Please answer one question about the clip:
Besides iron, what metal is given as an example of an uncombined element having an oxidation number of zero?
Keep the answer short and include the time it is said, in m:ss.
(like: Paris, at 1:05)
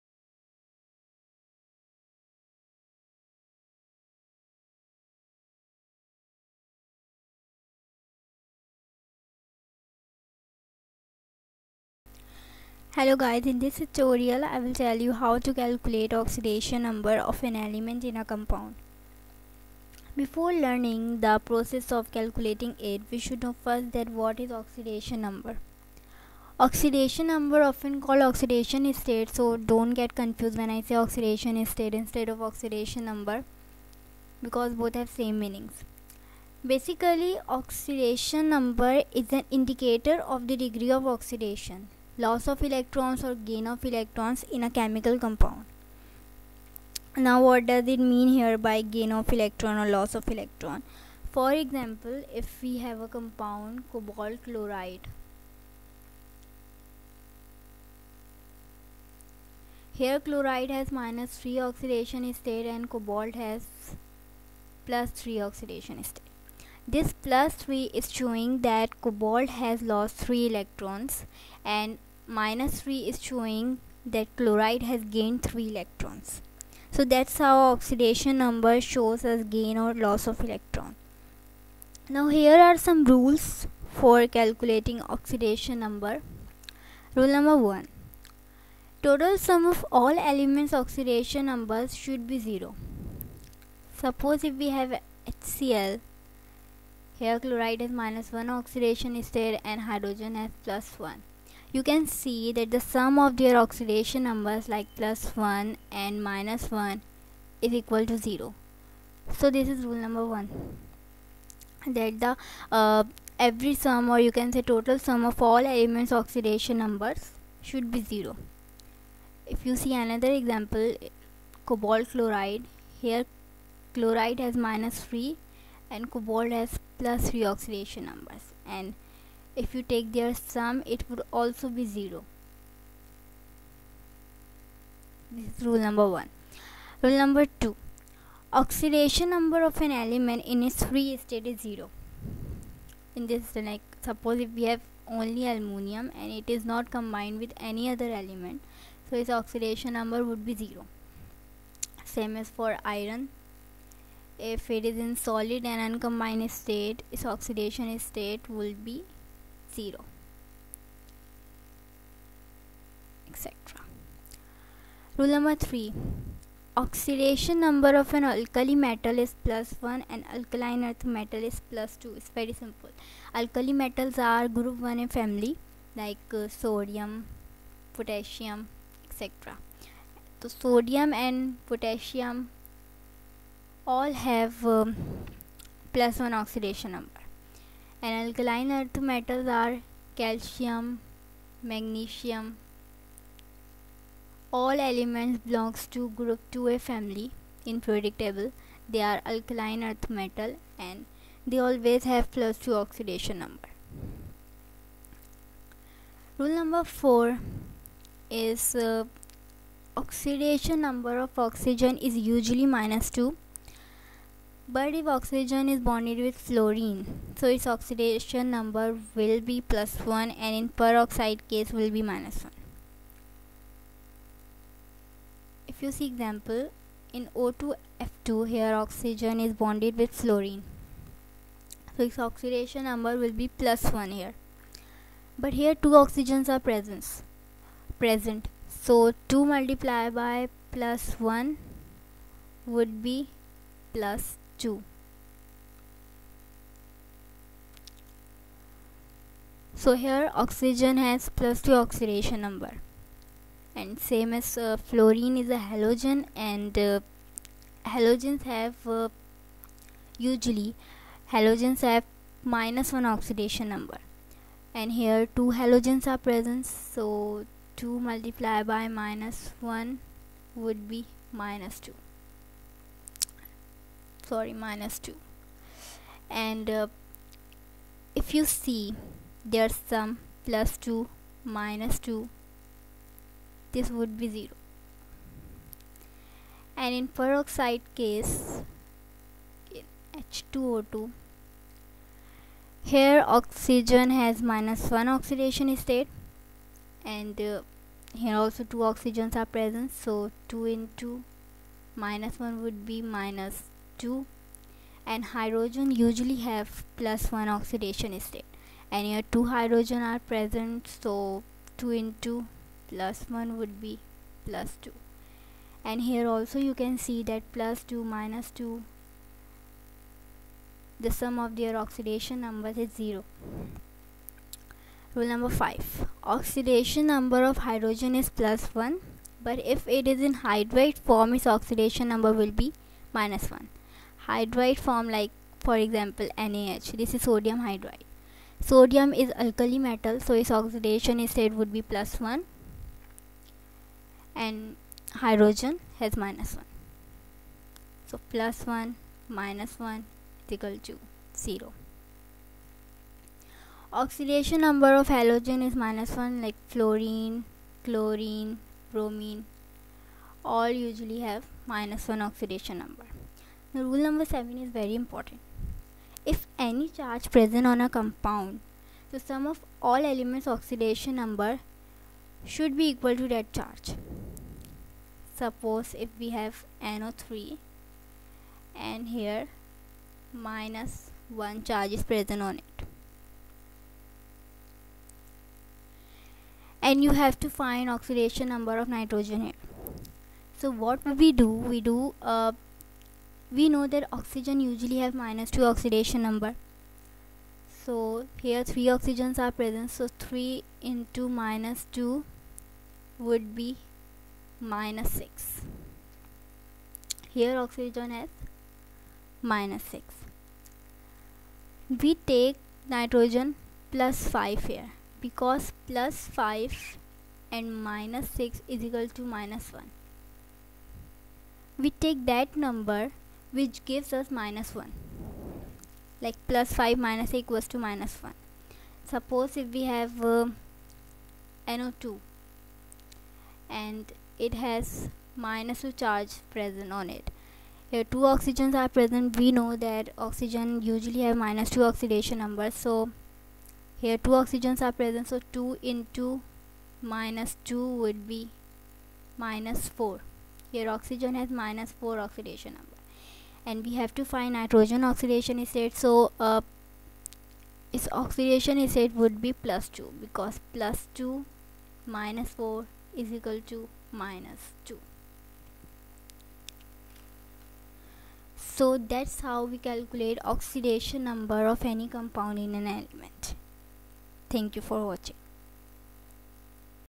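aluminum, at 2:25.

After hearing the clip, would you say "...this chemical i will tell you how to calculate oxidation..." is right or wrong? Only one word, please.
wrong.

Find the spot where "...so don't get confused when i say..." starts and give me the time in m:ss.
0:29.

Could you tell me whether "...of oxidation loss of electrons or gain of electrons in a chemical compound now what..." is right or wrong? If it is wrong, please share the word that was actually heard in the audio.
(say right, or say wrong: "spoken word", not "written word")
right.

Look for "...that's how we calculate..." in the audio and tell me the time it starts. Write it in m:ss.
7:48.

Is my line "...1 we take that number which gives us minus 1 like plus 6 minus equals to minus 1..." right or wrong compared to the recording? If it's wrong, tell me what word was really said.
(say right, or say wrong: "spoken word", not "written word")
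wrong: "5", not "6".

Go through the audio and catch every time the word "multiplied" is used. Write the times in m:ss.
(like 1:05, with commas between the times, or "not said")
3:59, 4:28.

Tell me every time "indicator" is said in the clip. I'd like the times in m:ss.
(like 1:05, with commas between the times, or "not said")
0:39.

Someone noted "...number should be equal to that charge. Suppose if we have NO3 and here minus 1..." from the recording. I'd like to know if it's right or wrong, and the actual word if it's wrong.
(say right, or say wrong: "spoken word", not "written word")
right.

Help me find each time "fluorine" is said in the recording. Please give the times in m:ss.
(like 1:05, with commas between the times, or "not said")
3:36, 3:50, 4:14, 5:56.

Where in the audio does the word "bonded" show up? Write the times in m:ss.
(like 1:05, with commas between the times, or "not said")
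3:35, 3:49.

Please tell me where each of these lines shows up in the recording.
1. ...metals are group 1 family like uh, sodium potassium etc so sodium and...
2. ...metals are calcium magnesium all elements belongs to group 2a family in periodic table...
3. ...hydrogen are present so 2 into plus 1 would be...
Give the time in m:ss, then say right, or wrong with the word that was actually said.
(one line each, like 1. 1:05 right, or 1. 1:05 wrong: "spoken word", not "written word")
1. 2:53 right
2. 3:09 right
3. 5:09 right.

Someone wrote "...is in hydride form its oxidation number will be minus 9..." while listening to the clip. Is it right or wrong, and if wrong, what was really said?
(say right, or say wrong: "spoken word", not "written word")
wrong: "1", not "9".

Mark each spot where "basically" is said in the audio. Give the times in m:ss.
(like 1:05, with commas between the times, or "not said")
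0:36.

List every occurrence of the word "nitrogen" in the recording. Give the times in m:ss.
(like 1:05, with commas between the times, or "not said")
6:28, 6:52, 7:34.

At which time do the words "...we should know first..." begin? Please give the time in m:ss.
0:23.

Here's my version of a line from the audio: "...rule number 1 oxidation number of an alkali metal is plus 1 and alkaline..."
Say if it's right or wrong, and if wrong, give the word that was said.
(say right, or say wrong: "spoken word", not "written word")
wrong: "3", not "1".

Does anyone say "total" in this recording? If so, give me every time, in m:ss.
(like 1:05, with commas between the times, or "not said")
1:29, 1:54.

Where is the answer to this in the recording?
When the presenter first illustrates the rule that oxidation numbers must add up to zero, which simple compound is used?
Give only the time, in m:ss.
1:35.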